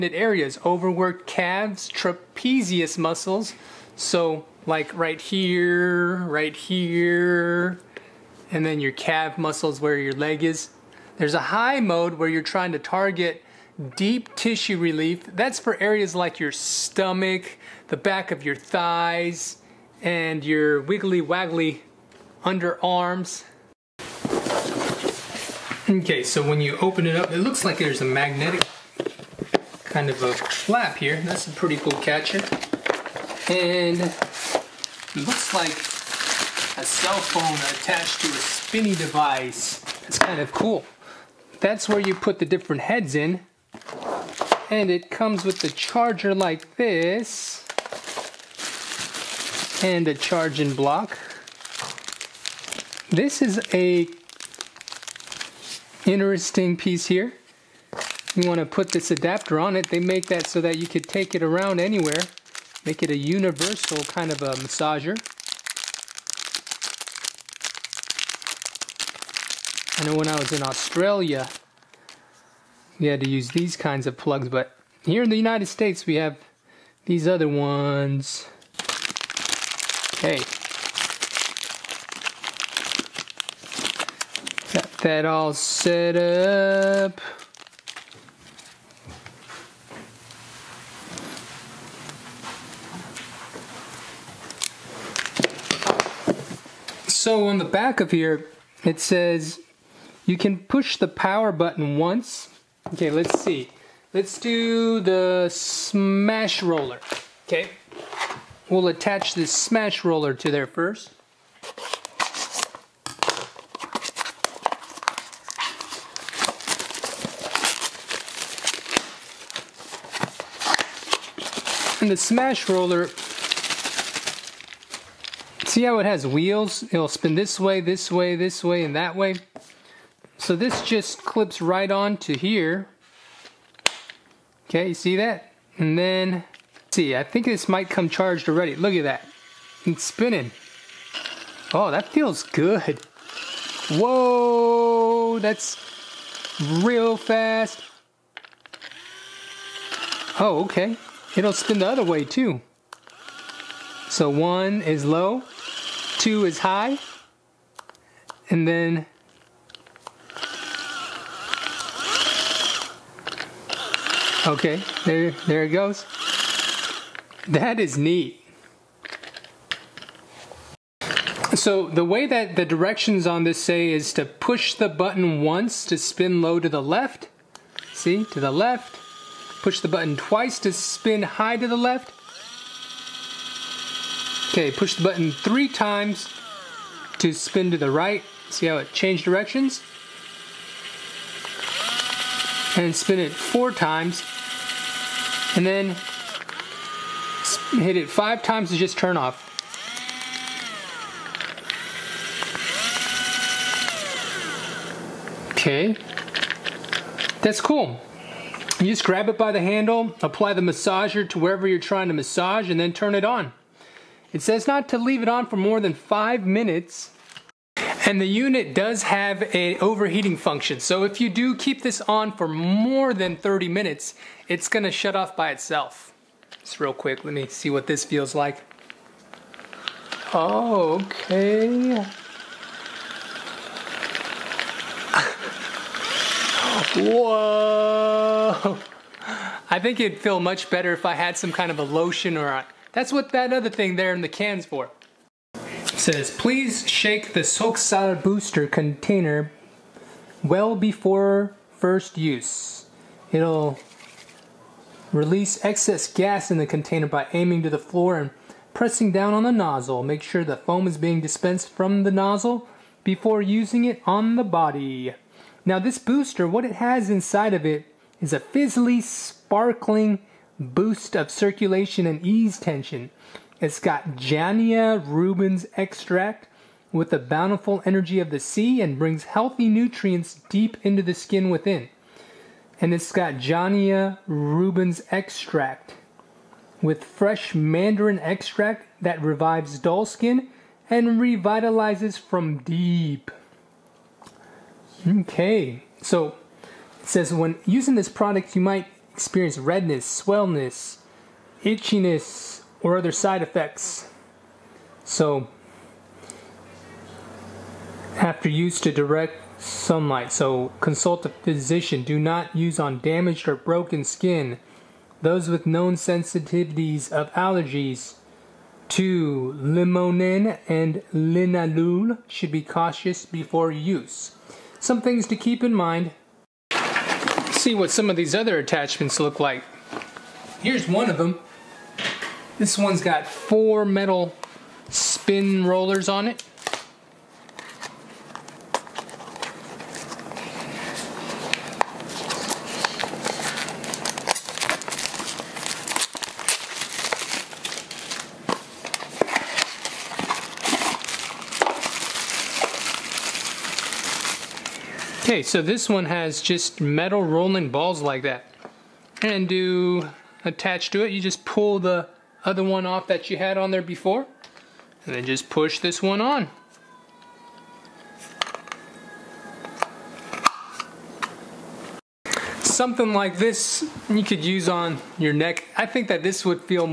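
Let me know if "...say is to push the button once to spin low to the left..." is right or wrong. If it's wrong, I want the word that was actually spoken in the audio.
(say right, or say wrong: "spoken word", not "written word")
right.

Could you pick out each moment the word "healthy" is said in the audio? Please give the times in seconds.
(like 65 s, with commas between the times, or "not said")
279 s.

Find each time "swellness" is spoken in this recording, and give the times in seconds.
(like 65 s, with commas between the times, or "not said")
300 s.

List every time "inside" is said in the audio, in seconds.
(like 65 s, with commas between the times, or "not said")
267 s.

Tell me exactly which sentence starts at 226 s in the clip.
Just real quick, let me see what this feels like.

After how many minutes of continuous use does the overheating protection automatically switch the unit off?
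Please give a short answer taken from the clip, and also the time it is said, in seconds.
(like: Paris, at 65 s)
30, at 223 s.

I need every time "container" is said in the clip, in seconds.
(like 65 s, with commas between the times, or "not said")
248 s, 256 s.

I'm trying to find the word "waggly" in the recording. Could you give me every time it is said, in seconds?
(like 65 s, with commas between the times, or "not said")
21 s.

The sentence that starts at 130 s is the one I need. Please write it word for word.
So this just clips right on to here.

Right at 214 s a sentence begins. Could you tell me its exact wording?
It says not to leave it on for more than five minutes and the unit does have a overheating function.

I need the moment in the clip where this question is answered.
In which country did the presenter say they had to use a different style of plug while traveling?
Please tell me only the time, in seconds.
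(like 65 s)
70 s.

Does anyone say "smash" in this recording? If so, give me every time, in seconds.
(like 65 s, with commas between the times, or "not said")
105 s, 109 s, 122 s.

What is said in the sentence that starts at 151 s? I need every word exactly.
It'll spin the other way too.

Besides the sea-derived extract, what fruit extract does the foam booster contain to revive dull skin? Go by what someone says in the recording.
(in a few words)
Mandarin.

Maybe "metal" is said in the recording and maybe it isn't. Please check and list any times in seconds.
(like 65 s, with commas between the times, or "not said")
333 s, 356 s.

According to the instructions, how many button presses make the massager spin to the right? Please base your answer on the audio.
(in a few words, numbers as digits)
3.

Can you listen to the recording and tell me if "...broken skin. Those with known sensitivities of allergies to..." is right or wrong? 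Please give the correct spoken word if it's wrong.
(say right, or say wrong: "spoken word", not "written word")
right.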